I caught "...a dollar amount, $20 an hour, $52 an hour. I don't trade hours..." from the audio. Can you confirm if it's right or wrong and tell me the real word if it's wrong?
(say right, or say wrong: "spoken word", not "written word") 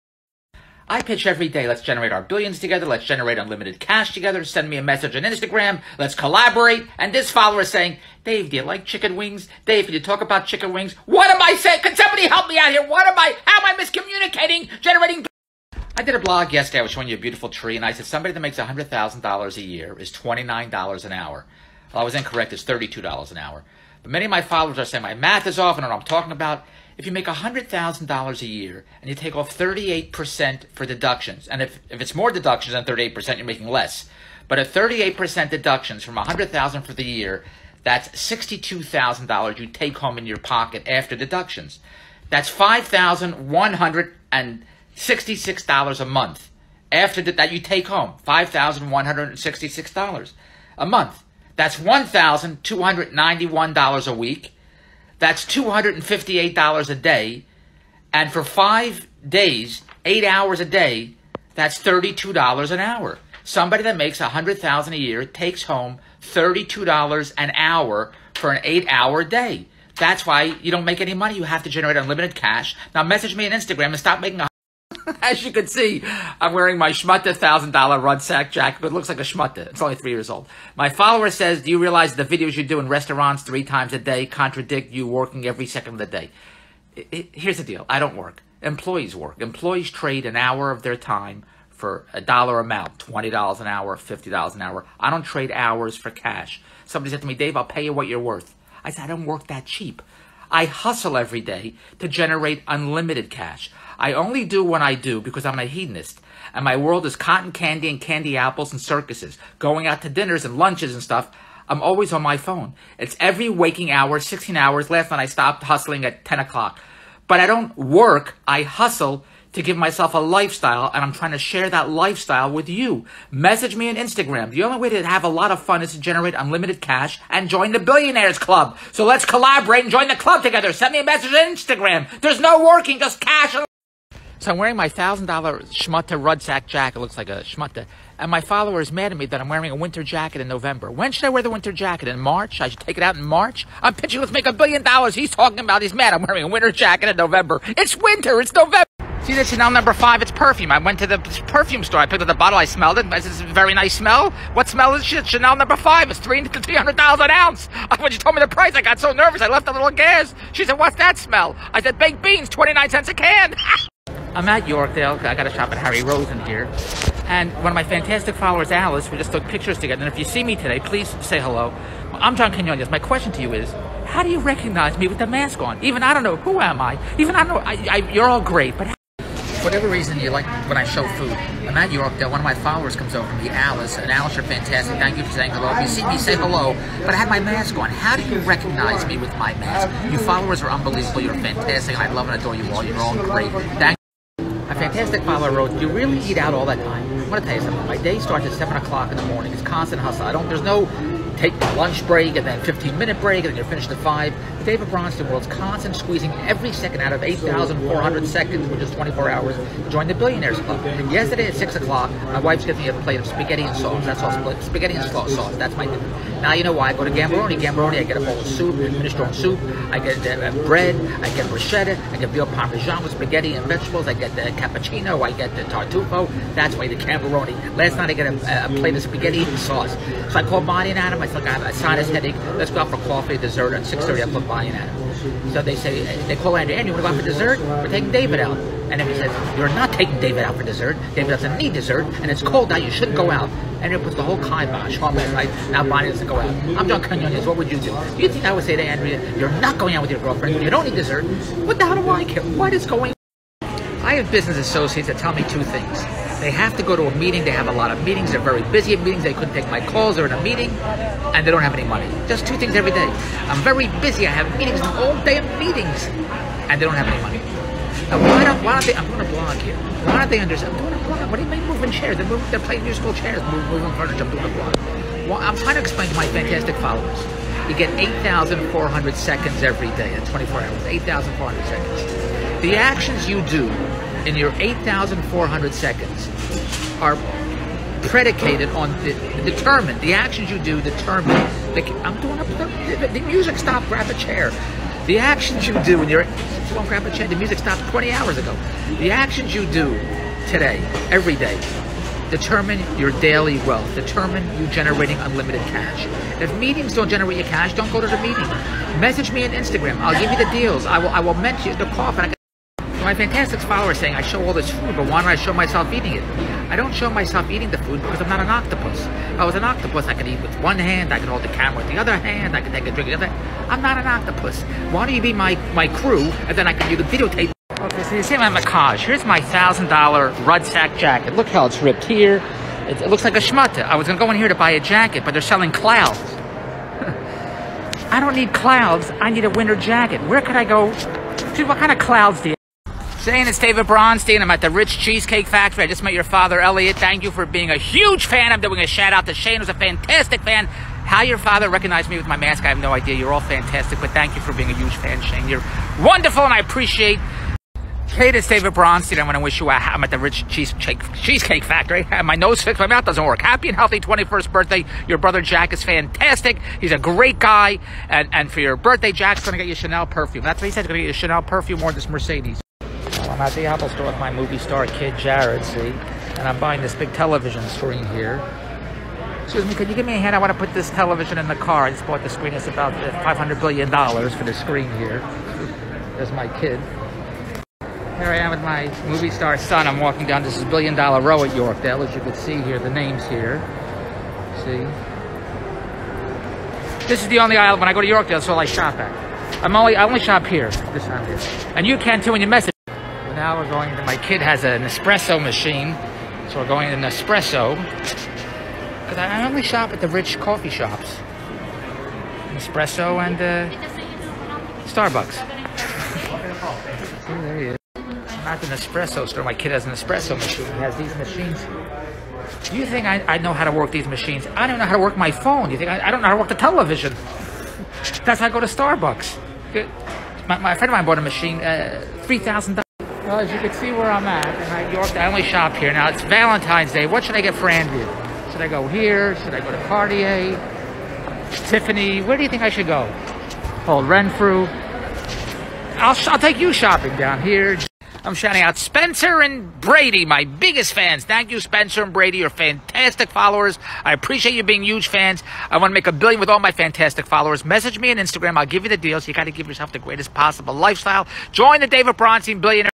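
wrong: "50", not "52".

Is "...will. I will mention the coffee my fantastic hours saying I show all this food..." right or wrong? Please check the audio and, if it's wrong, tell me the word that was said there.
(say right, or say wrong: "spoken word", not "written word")
wrong: "followers", not "hours".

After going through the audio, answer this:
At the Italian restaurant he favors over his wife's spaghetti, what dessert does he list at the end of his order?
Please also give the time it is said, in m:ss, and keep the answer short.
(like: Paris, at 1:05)
tartufo, at 3:45.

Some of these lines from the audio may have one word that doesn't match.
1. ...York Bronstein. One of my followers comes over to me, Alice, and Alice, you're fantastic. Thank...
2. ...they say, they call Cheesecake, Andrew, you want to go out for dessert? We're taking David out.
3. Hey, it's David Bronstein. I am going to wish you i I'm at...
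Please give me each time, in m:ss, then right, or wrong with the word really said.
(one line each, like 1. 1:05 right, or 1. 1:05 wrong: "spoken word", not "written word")
1. 3:01 wrong: "Yorkdale", not "Bronstein"
2. 3:55 wrong: "Andrew", not "Cheesecake"
3. 5:58 right.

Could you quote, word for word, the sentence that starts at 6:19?
Excuse me, could you give me a hand?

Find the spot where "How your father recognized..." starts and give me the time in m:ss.
5:51.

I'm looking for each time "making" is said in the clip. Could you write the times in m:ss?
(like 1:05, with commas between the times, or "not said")
1:14.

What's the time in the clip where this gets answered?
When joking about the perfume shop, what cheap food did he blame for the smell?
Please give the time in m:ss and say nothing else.
2:41.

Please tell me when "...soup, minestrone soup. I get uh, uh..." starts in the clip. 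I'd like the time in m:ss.
3:38.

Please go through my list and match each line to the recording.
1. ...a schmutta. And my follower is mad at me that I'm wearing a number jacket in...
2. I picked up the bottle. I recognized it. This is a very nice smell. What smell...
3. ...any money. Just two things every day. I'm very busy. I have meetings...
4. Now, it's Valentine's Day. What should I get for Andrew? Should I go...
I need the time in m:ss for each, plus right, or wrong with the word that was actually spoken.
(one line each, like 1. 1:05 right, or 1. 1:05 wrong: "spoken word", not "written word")
1. 2:17 wrong: "winter", not "number"
2. 2:31 wrong: "smelled", not "recognized"
3. 4:21 right
4. 7:15 right.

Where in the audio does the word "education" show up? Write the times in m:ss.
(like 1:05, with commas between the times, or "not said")
not said.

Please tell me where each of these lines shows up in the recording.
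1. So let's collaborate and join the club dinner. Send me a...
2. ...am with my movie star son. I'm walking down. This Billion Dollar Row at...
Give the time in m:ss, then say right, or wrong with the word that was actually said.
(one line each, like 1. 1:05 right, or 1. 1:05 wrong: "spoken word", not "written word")
1. 2:08 wrong: "together", not "dinner"
2. 6:28 right.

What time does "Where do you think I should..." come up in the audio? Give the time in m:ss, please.
7:22.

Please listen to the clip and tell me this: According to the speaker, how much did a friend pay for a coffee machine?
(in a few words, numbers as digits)
$3,000.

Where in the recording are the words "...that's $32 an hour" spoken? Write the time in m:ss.
1:01.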